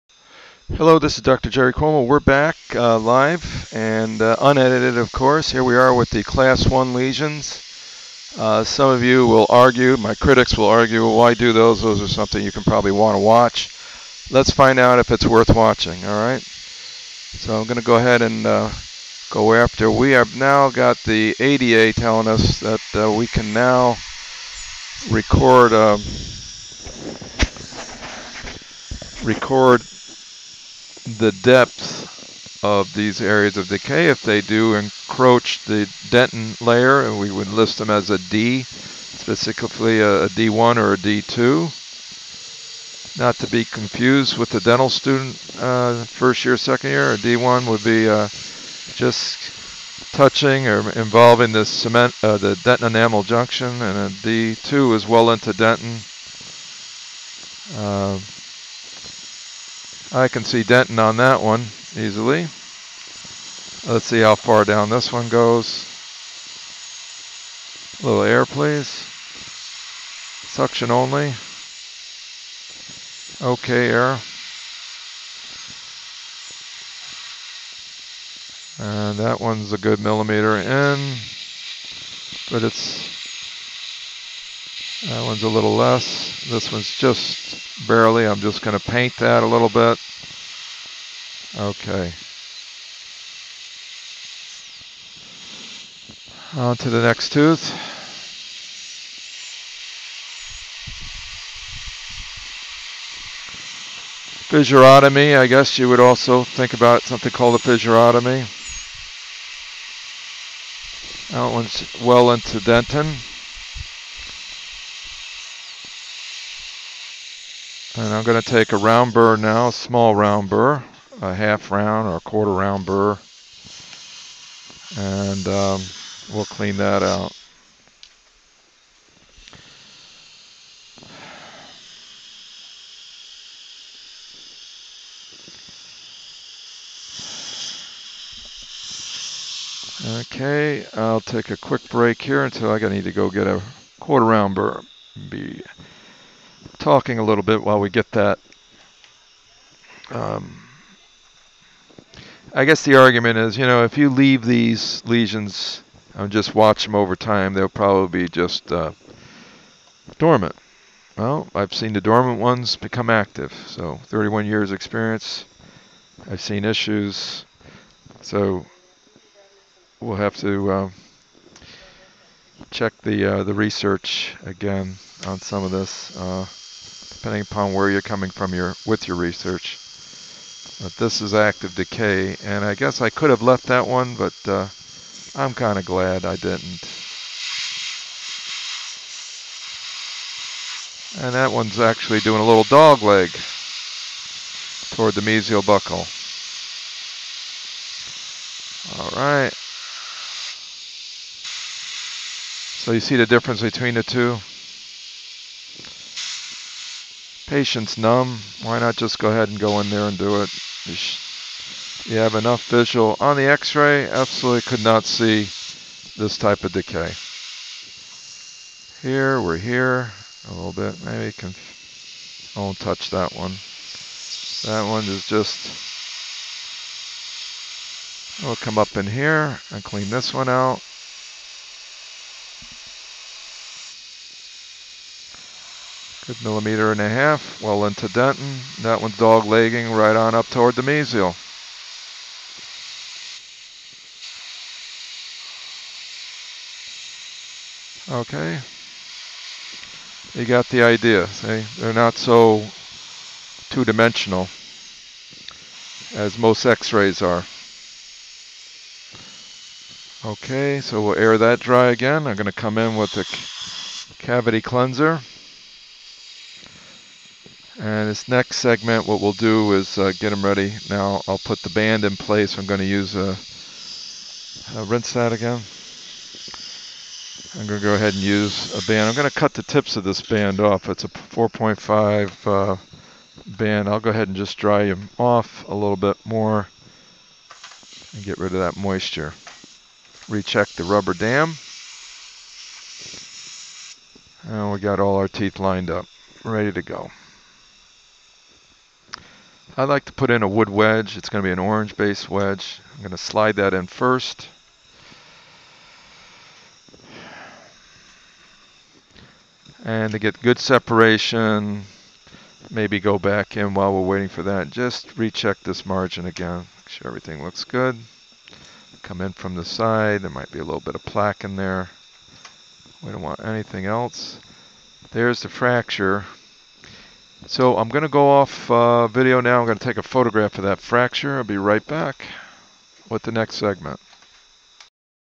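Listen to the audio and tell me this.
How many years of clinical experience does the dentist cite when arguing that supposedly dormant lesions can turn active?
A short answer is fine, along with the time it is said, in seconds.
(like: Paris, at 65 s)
31, at 164 s.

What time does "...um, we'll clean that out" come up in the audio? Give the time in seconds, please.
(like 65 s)
125 s.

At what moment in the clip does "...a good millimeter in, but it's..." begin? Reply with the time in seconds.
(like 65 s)
79 s.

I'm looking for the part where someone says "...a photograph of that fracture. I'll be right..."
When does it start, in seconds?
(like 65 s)
329 s.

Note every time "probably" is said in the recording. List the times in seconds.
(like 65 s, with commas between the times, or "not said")
12 s, 157 s.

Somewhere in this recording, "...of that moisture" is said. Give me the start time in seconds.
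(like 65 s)
288 s.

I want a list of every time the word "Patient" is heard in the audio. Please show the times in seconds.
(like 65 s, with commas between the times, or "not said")
207 s.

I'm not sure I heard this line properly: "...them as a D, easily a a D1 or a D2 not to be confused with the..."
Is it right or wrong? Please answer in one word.
wrong.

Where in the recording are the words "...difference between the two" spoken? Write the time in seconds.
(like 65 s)
203 s.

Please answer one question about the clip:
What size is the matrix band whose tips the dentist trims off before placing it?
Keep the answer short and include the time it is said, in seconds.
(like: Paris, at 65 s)
4.5, at 281 s.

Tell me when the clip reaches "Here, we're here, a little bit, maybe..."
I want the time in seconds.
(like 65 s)
219 s.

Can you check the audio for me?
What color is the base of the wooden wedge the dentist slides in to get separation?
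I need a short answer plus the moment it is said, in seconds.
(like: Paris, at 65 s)
orange, at 301 s.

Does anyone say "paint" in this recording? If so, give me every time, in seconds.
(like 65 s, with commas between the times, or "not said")
88 s.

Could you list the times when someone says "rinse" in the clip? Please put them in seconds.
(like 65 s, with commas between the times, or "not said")
274 s.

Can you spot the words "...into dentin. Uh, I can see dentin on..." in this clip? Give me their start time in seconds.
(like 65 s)
55 s.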